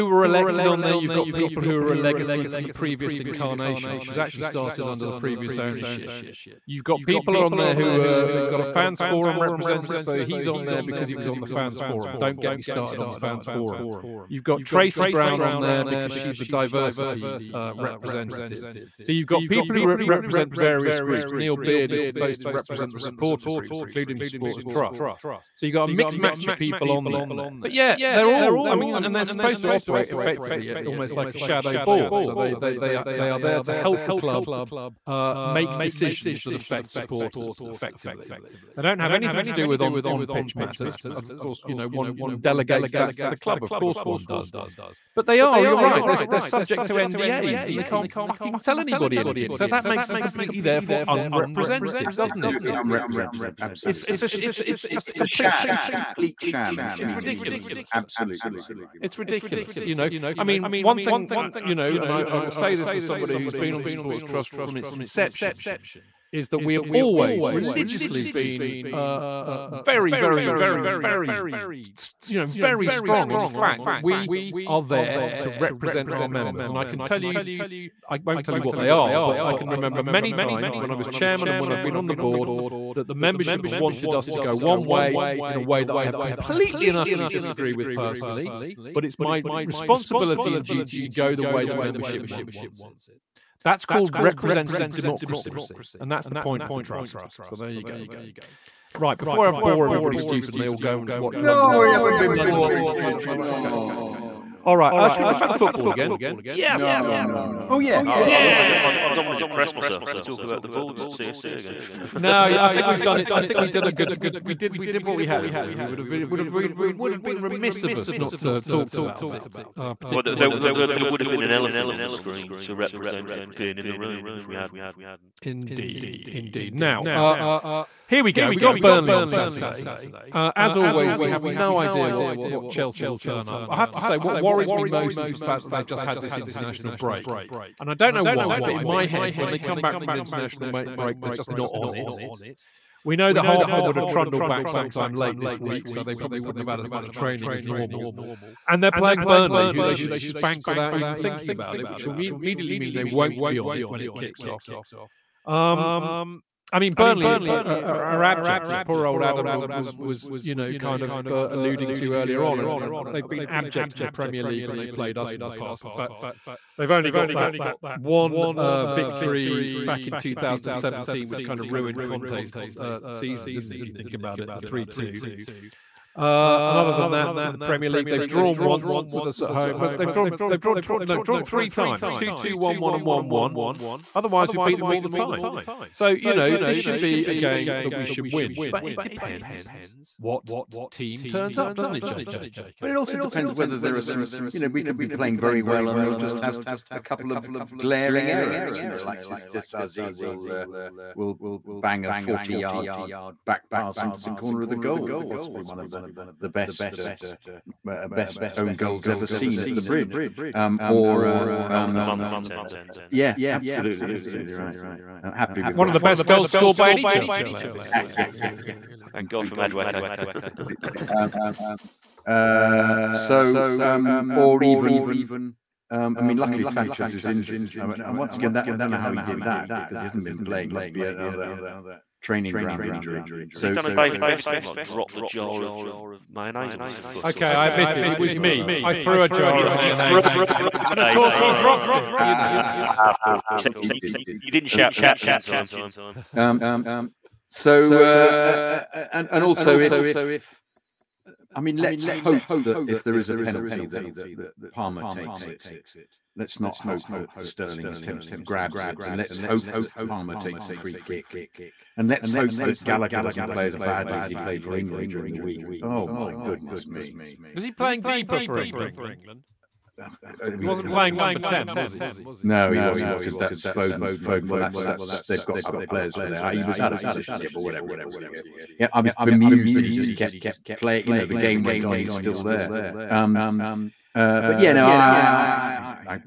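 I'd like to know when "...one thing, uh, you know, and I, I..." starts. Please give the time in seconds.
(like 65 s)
60 s.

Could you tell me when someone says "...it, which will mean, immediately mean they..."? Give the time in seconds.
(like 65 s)
151 s.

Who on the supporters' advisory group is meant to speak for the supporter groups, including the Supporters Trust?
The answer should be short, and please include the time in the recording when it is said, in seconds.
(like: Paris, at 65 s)
Neil Beard, at 21 s.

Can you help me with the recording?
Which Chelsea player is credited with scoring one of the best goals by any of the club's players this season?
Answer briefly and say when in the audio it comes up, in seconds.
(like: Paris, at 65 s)
Madueke, at 219 s.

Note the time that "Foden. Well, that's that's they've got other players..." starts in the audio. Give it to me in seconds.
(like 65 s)
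274 s.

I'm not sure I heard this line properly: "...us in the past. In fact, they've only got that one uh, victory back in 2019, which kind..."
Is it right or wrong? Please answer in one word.
wrong.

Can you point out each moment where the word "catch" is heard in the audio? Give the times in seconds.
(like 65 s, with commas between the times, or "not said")
244 s.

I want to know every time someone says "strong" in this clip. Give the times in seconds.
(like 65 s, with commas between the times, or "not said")
72 s.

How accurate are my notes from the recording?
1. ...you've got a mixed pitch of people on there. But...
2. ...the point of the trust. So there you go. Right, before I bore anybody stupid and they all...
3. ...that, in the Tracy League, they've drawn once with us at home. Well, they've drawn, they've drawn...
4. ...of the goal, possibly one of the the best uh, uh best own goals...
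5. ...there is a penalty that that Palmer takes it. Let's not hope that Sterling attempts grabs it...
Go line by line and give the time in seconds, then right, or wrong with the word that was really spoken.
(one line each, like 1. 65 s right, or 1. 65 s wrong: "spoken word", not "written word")
1. 25 s wrong: "match", not "pitch"
2. 96 s wrong: "everybody", not "anybody"
3. 177 s wrong: "Premier", not "Tracy"
4. 204 s right
5. 253 s right.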